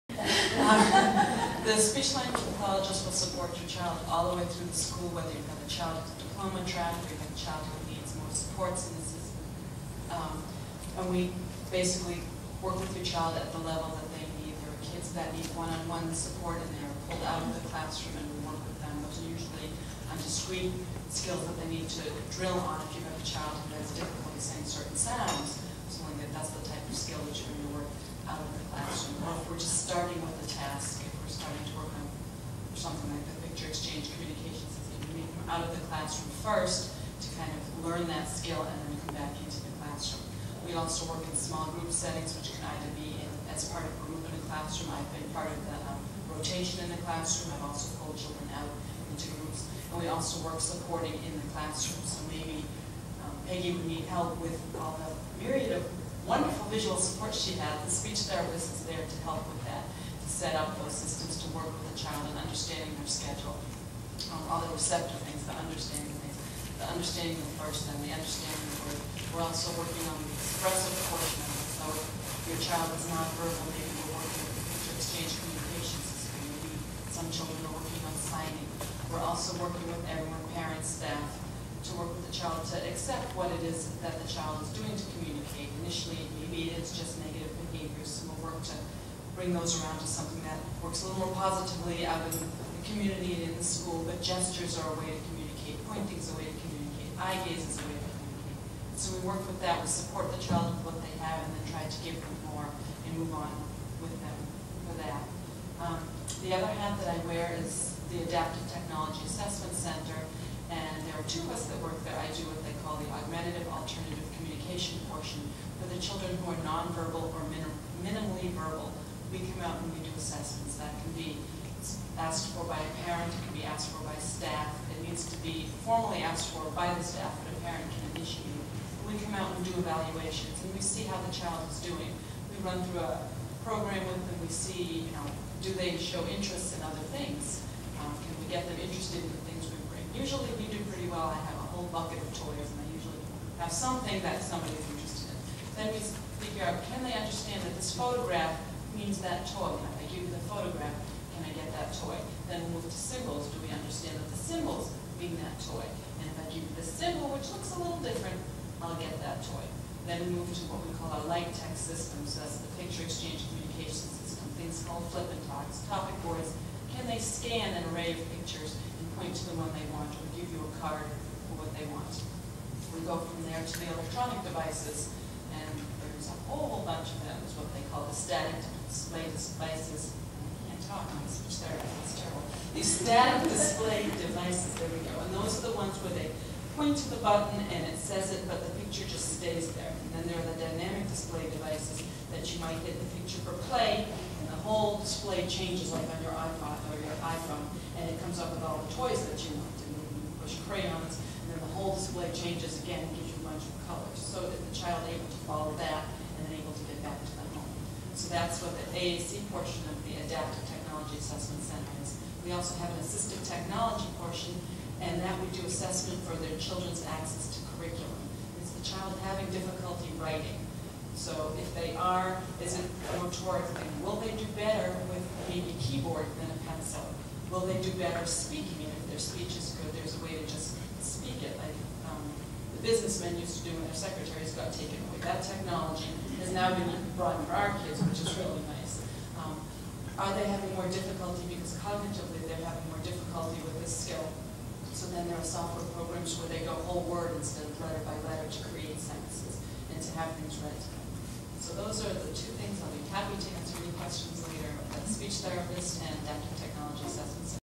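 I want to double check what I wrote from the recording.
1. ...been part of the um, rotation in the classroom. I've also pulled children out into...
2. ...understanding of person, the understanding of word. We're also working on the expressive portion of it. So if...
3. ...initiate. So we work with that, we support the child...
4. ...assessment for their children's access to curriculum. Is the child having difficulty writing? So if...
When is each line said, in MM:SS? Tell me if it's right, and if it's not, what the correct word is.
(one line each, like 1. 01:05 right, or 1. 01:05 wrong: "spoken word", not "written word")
1. 00:45 right
2. 01:06 right
3. 01:38 wrong: "communicate", not "initiate"
4. 03:35 right.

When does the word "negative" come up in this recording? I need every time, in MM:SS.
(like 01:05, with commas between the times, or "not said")
01:27.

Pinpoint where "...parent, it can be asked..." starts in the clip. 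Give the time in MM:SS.
02:03.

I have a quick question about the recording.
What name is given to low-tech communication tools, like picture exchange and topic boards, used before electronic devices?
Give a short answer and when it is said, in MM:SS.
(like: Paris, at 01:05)
light tech system, at 02:41.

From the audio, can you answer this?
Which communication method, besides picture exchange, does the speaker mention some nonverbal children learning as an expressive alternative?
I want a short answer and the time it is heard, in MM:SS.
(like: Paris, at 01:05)
signing, at 01:18.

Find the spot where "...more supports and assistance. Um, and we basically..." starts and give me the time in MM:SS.
00:08.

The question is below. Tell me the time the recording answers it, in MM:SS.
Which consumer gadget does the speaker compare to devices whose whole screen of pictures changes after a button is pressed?
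03:16.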